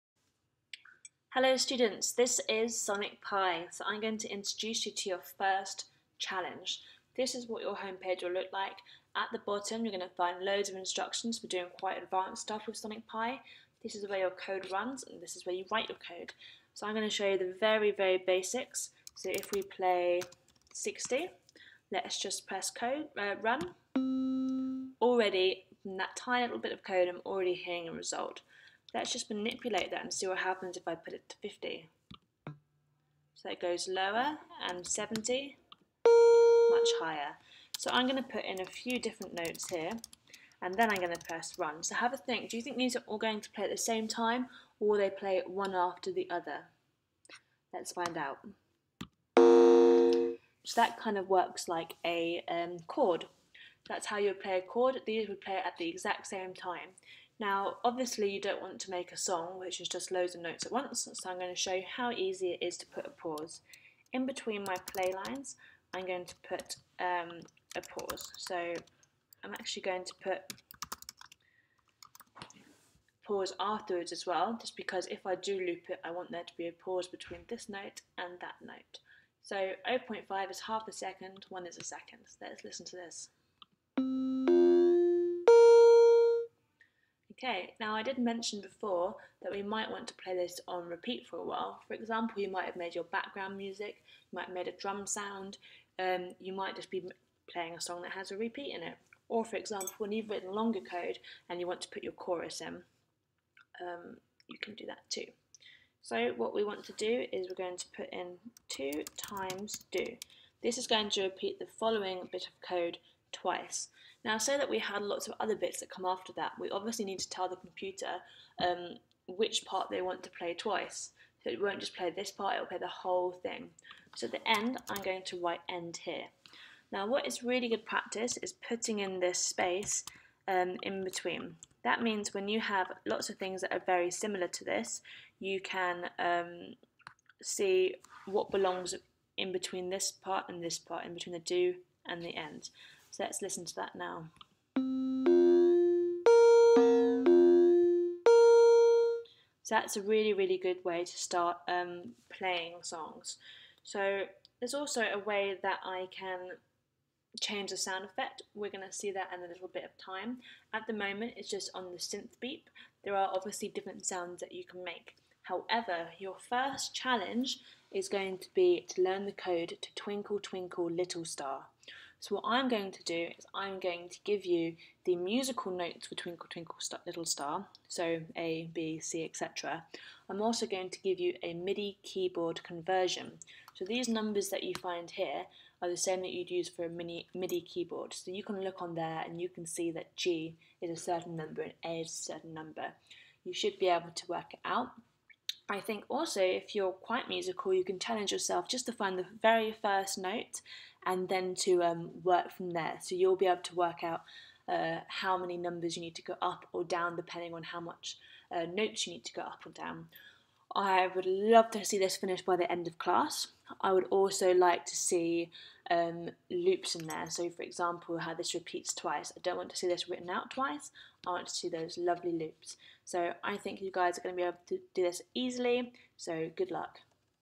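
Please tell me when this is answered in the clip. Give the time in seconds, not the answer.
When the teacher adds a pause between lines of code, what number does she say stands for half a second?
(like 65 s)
79 s.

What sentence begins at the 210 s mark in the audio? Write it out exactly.
I would love to see this finished by the end of class.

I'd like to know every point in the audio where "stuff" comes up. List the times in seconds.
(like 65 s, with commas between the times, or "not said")
12 s.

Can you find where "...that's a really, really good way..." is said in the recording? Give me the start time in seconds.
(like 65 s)
149 s.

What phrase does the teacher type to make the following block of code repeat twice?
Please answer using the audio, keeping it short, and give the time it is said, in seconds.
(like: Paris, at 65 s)
two times do, at 108 s.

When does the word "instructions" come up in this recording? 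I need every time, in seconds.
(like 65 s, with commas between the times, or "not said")
10 s.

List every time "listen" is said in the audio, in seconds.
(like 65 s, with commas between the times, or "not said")
82 s, 143 s.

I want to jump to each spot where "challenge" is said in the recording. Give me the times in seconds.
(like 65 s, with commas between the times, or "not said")
6 s, 166 s, 197 s.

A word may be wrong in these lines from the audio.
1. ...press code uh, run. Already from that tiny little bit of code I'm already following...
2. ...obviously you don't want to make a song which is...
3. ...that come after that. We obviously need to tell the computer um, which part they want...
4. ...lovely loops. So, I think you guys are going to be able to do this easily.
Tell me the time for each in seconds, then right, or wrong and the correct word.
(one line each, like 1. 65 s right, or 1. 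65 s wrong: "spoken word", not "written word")
1. 22 s wrong: "hearing", not "following"
2. 57 s right
3. 115 s right
4. 221 s right.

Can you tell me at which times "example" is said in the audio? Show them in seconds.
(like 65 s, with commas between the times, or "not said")
91 s, 99 s, 217 s.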